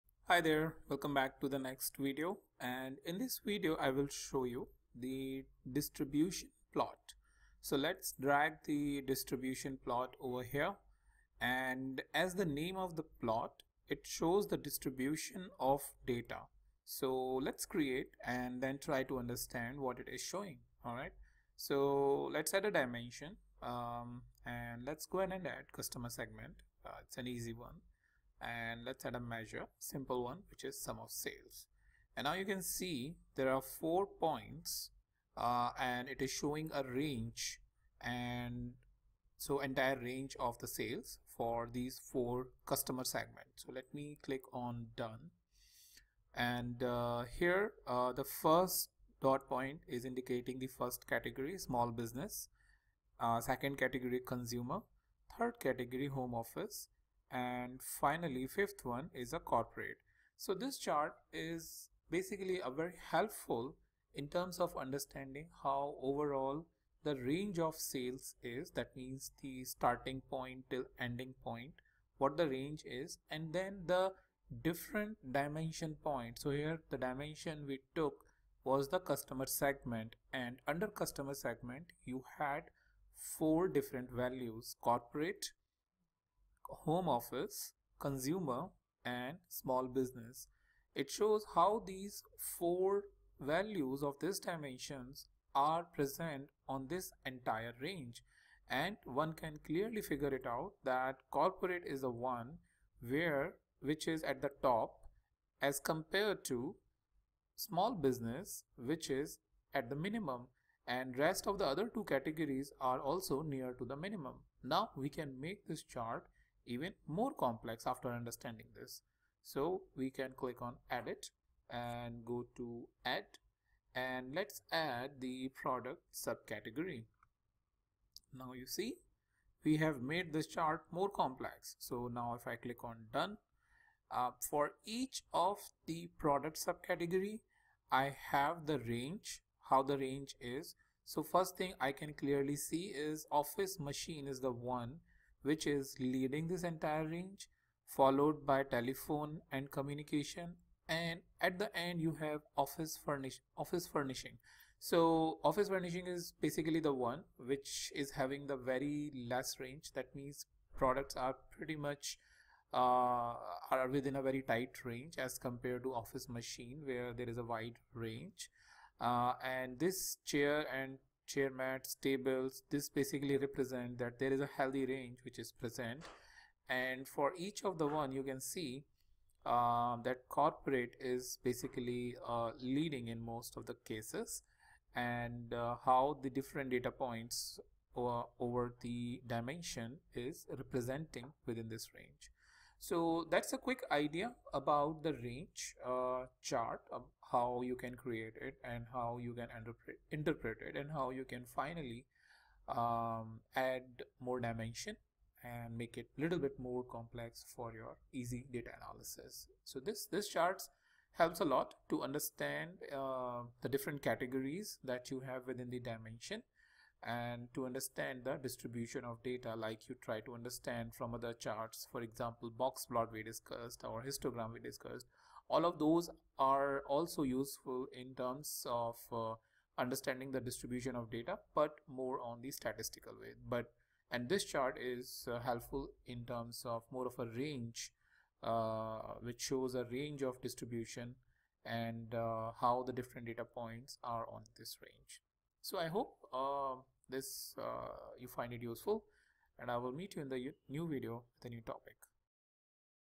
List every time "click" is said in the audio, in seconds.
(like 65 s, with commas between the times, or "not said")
44 s, 120 s, 132 s.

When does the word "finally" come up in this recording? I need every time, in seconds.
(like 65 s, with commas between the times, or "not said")
57 s, 201 s.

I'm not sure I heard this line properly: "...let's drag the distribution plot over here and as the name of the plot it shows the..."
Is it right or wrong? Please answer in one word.
right.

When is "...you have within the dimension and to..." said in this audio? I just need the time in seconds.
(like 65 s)
215 s.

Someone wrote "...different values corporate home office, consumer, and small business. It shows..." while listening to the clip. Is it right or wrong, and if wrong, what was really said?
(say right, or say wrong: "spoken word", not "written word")
right.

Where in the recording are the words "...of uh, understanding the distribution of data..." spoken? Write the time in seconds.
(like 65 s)
228 s.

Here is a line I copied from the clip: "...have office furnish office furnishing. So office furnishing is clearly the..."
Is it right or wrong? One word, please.
wrong.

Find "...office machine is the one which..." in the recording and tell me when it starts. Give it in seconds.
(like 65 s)
143 s.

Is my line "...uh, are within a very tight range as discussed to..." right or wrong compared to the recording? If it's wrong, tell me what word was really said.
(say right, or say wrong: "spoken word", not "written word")
wrong: "compared", not "discussed".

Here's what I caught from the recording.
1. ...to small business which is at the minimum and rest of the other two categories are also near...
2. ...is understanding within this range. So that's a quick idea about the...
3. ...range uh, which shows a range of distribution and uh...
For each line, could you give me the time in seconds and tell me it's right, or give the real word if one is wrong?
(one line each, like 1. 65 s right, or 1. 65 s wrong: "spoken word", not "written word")
1. 106 s right
2. 190 s wrong: "representing", not "understanding"
3. 237 s right.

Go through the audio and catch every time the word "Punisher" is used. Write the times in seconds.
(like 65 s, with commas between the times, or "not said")
not said.